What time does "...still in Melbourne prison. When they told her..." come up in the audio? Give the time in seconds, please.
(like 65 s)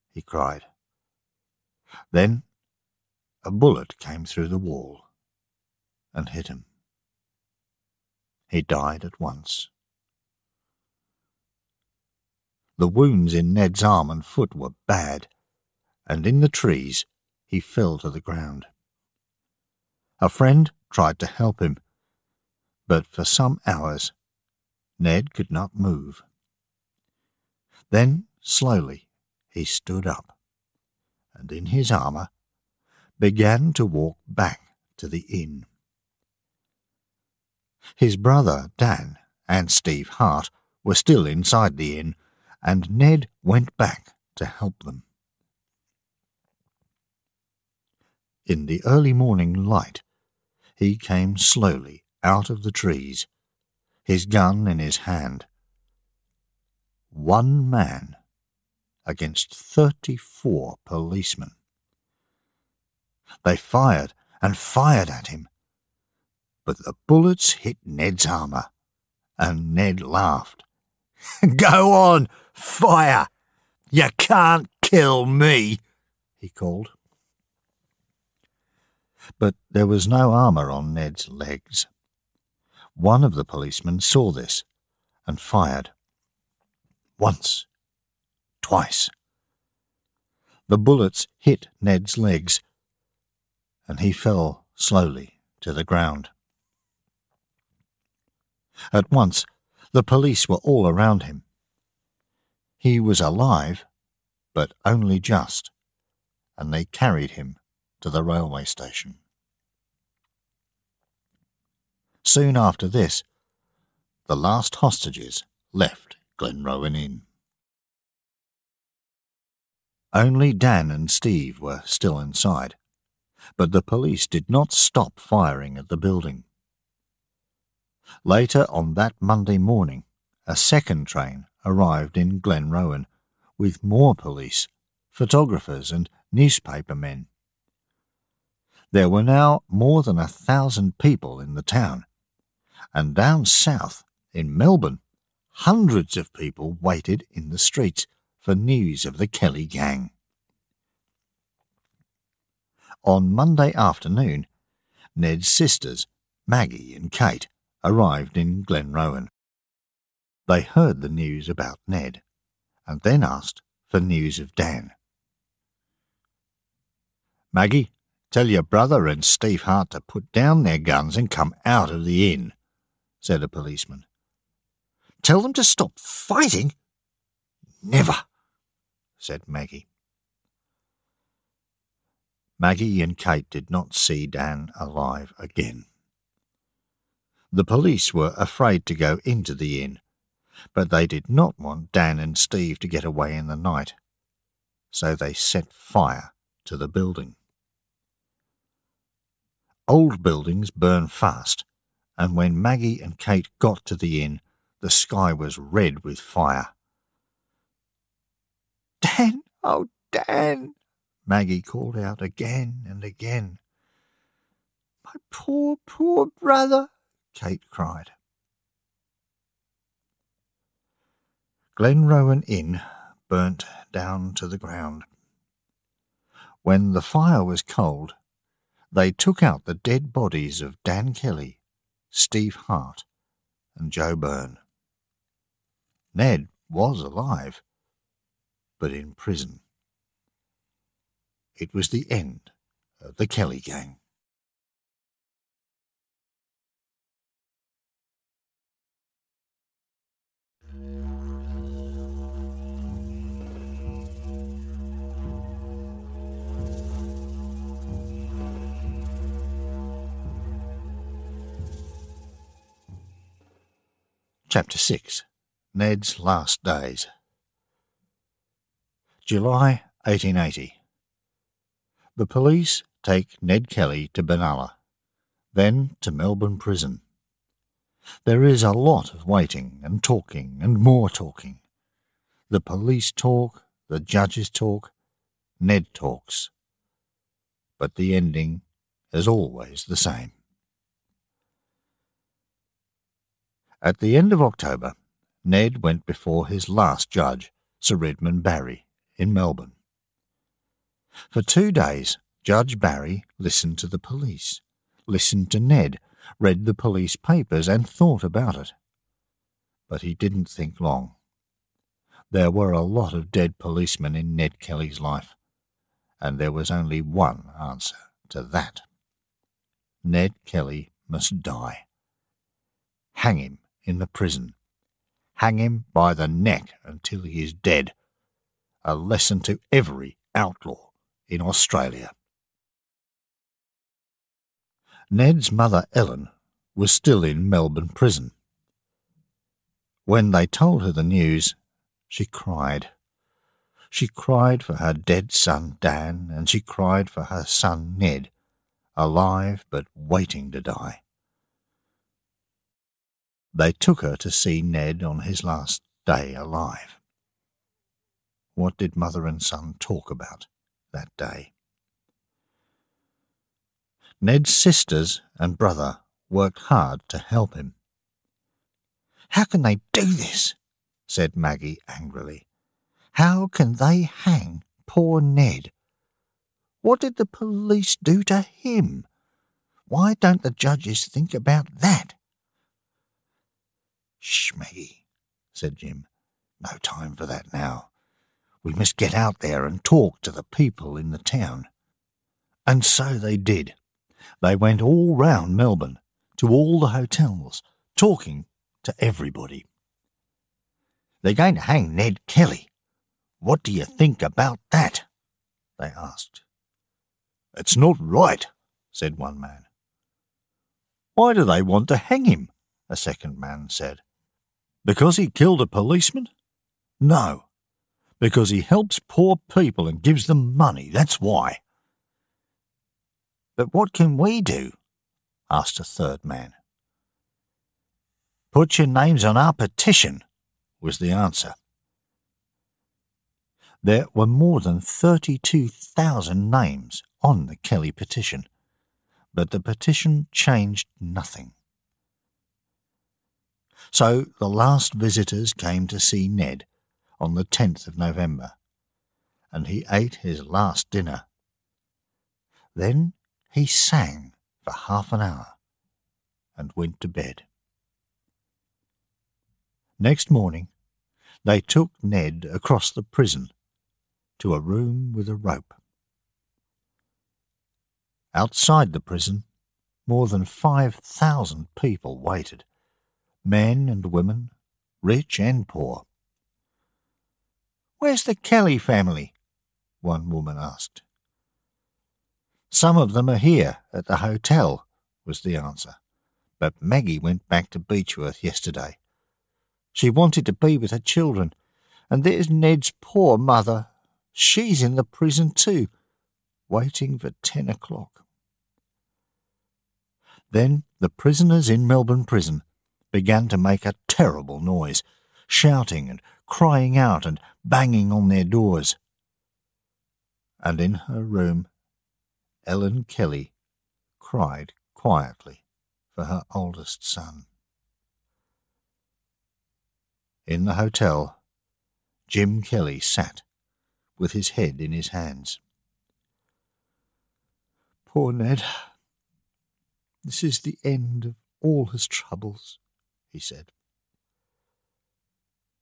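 336 s.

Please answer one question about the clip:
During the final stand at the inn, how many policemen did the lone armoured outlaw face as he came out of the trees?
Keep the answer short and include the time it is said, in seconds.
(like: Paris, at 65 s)
34, at 59 s.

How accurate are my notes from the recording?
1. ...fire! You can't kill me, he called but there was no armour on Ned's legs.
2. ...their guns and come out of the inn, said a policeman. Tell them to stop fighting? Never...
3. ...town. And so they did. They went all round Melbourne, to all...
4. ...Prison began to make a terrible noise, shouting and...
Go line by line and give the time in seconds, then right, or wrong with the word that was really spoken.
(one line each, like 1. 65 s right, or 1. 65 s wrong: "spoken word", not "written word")
1. 72 s right
2. 170 s right
3. 391 s right
4. 502 s right.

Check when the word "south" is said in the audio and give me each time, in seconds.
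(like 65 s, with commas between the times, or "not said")
143 s.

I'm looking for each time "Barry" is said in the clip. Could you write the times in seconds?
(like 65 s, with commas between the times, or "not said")
298 s, 302 s.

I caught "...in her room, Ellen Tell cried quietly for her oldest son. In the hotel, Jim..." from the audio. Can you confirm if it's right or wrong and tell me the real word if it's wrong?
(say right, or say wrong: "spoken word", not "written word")
wrong: "Kelly", not "Tell".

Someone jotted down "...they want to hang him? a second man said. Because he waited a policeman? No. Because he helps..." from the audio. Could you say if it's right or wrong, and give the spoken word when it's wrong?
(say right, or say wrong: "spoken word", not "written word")
wrong: "killed", not "waited".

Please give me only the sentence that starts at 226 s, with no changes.
When the fire was cold, they took out the dead bodies of Dan Kelly, Steve Hart, and Joe Byrne.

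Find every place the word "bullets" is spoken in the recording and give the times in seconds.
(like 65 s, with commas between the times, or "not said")
3 s, 67 s, 90 s.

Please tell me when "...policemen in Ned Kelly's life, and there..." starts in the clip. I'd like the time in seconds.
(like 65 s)
313 s.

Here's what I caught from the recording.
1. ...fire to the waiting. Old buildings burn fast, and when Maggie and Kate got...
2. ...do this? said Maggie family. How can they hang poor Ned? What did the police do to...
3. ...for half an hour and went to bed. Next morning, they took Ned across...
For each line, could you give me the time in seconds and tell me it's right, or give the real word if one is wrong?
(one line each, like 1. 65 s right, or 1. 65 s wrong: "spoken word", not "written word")
1. 195 s wrong: "building", not "waiting"
2. 369 s wrong: "angrily", not "family"
3. 454 s right.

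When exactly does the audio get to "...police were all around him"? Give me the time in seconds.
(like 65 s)
100 s.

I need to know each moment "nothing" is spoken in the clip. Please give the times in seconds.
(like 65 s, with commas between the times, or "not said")
440 s.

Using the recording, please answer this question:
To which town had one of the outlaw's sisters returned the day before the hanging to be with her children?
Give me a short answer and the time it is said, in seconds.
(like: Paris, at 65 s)
Beechworth, at 487 s.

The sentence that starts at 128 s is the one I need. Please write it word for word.
Later on that Monday morning, a second train arrived in Glenrowan with more police, photographers, and newspapermen.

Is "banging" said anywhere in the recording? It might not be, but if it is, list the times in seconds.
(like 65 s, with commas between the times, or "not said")
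507 s.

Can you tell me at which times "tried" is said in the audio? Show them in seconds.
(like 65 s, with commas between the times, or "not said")
20 s.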